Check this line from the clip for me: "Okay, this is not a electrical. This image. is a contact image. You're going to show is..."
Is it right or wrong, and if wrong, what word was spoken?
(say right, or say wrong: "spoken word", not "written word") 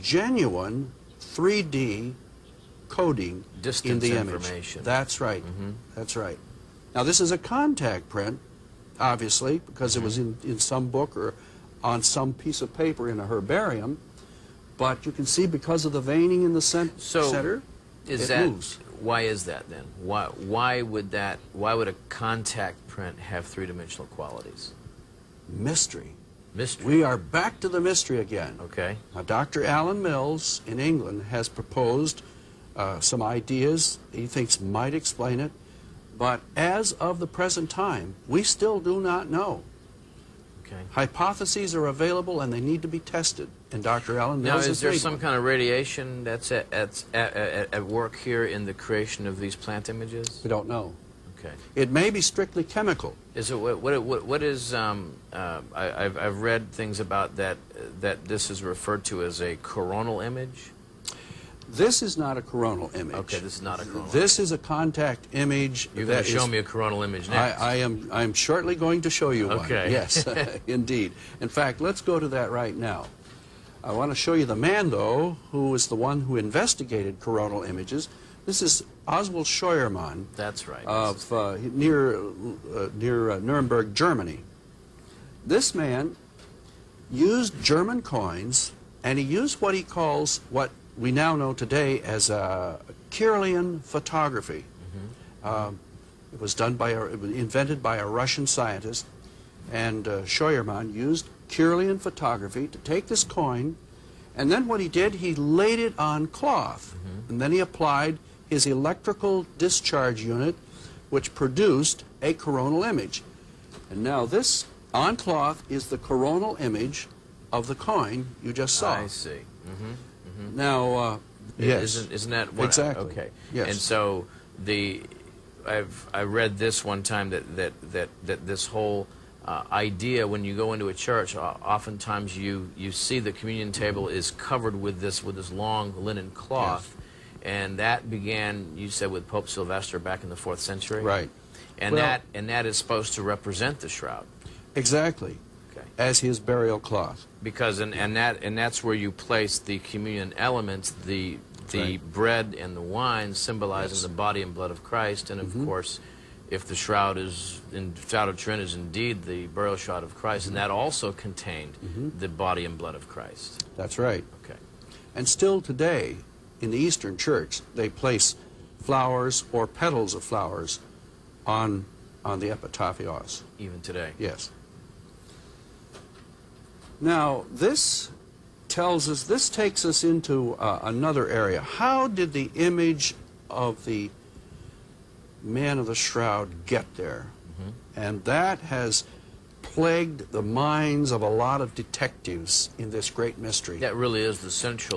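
wrong: "coronal", not "electrical".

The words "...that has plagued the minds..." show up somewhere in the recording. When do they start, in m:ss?
3:08.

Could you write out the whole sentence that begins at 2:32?
bread and the wine symbolizing yes.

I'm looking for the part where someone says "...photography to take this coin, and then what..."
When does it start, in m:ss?
1:41.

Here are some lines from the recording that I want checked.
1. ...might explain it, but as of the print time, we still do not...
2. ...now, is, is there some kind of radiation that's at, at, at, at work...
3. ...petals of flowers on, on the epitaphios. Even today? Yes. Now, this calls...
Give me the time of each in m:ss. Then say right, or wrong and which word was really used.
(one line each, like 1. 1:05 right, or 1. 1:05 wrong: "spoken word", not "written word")
1. 0:34 wrong: "present", not "print"
2. 0:44 right
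3. 2:49 wrong: "tells", not "calls".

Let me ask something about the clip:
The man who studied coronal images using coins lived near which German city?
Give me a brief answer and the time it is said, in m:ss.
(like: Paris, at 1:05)
Nuremberg, at 1:23.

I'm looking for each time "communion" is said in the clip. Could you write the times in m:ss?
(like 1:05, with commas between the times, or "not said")
2:13, 2:29.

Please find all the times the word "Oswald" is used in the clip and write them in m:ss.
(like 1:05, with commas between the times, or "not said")
1:19.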